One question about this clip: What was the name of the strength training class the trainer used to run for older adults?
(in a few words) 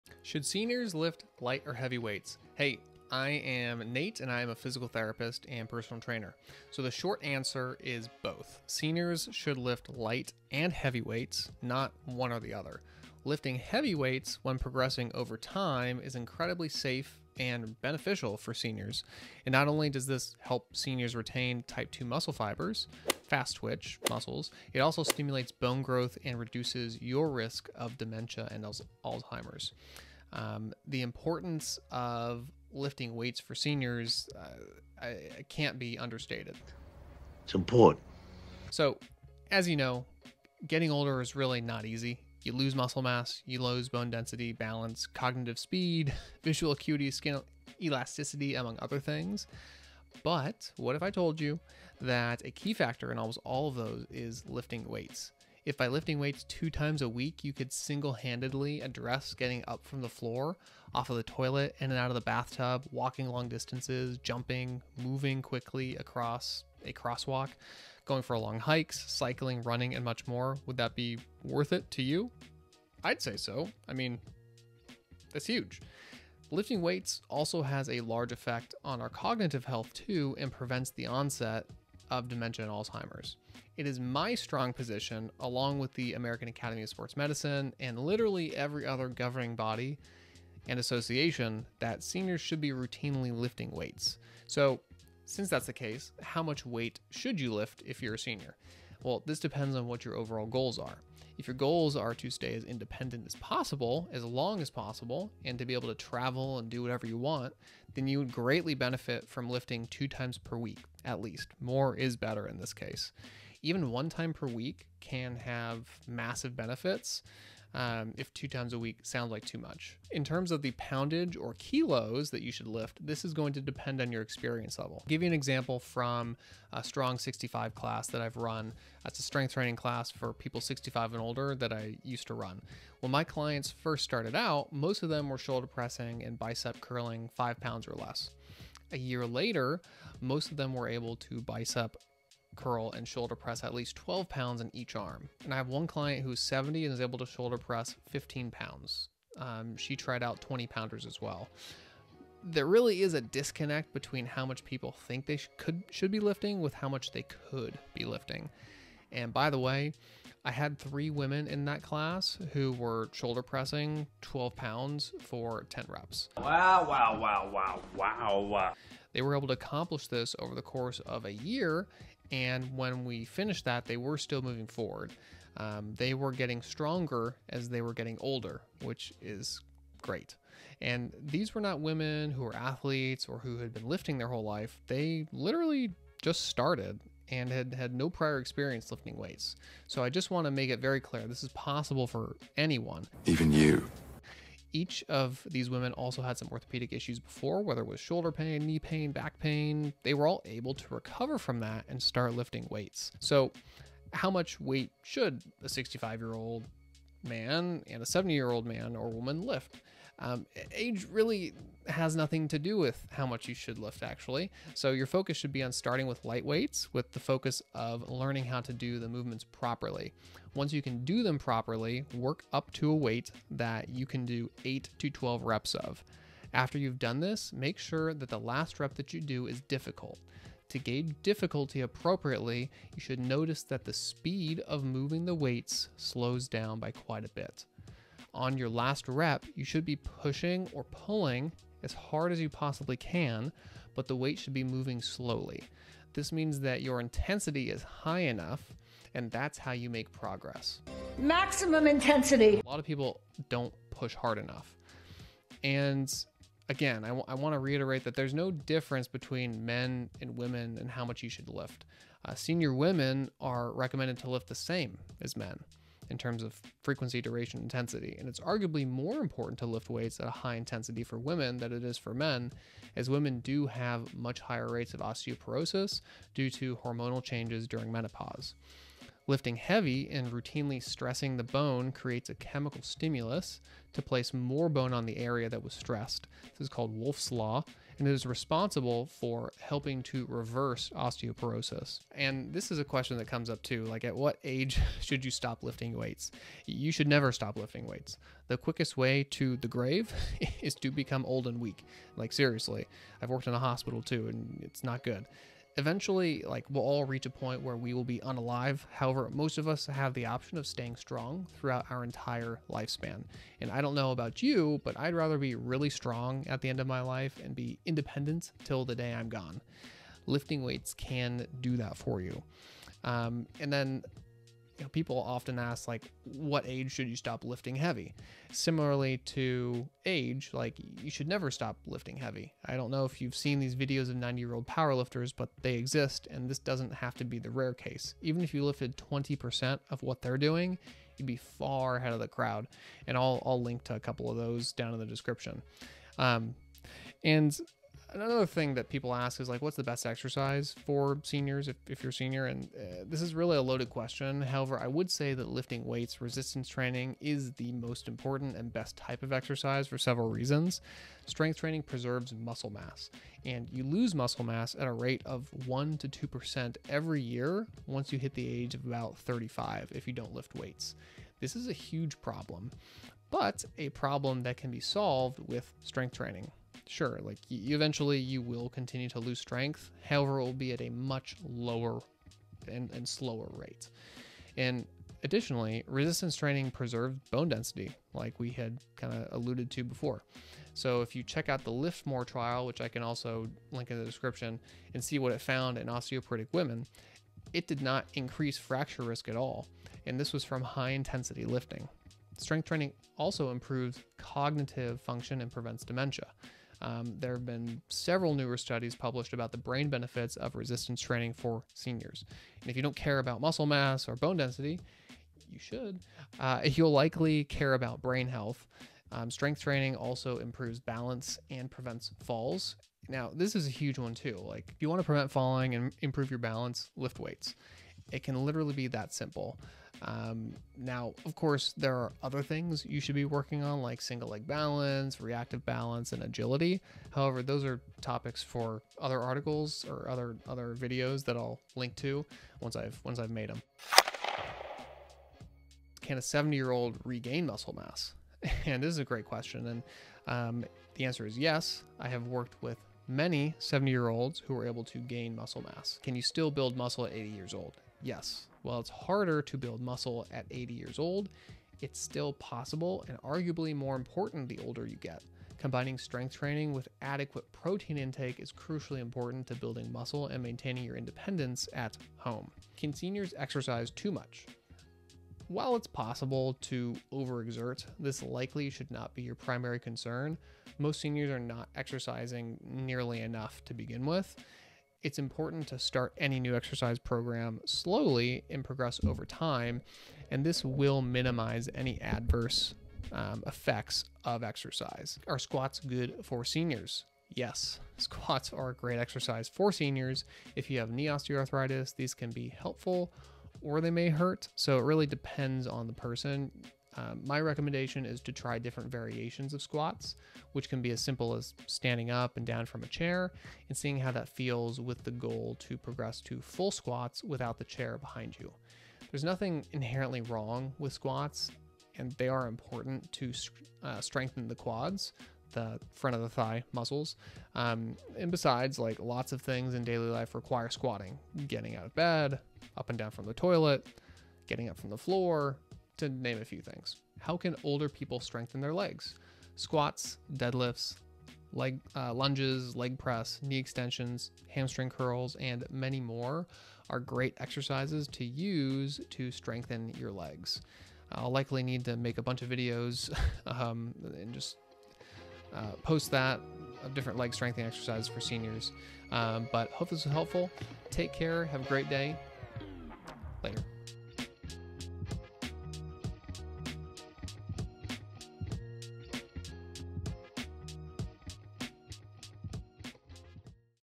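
Strong 65.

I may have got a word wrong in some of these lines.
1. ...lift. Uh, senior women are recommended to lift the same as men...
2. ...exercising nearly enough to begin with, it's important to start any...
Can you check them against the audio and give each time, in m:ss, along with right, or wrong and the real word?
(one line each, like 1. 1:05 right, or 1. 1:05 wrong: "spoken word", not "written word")
1. 4:21 right
2. 8:01 right.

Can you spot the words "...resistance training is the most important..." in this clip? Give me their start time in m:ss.
5:56.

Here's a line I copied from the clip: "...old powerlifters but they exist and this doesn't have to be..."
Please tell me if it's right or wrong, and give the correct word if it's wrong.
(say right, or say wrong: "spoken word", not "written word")
right.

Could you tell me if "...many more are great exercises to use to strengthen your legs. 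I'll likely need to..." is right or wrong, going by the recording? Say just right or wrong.
right.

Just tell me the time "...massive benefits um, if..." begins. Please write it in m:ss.
1:56.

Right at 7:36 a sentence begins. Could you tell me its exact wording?
Can you still build muscle at 80 years old?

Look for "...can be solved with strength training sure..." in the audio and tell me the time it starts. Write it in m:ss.
6:14.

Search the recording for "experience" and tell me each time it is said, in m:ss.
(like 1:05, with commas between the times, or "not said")
2:04, 3:08.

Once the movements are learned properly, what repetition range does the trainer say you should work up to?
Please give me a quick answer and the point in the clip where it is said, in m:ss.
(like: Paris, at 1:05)
8 to 12, at 3:44.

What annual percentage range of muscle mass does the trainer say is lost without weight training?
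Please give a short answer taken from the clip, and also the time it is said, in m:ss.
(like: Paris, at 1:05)
1% to 2%, at 6:05.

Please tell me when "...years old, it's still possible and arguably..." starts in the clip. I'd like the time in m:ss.
7:40.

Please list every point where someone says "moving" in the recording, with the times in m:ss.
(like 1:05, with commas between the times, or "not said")
1:04, 2:54, 3:54, 4:04.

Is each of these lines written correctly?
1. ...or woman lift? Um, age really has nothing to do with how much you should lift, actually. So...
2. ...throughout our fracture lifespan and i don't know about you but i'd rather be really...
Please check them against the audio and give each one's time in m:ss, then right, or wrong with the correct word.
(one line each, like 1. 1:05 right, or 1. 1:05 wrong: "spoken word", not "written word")
1. 3:28 right
2. 5:11 wrong: "entire", not "fracture".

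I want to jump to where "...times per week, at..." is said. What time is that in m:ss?
1:50.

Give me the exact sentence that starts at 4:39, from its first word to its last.
Lifting heavy and routinely stressing the bone creates a chemical stimulus to place more bone on the area that was stressed.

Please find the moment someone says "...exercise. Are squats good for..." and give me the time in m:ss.
8:14.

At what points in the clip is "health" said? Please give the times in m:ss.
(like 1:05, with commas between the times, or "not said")
1:19, 6:58.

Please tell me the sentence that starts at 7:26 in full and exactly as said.
Can a 70 year old regain muscle mass?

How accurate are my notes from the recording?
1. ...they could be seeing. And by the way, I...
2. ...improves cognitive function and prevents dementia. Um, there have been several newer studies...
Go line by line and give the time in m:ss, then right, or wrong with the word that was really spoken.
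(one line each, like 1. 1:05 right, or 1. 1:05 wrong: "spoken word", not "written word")
1. 2:37 wrong: "lifting", not "seeing"
2. 6:43 right.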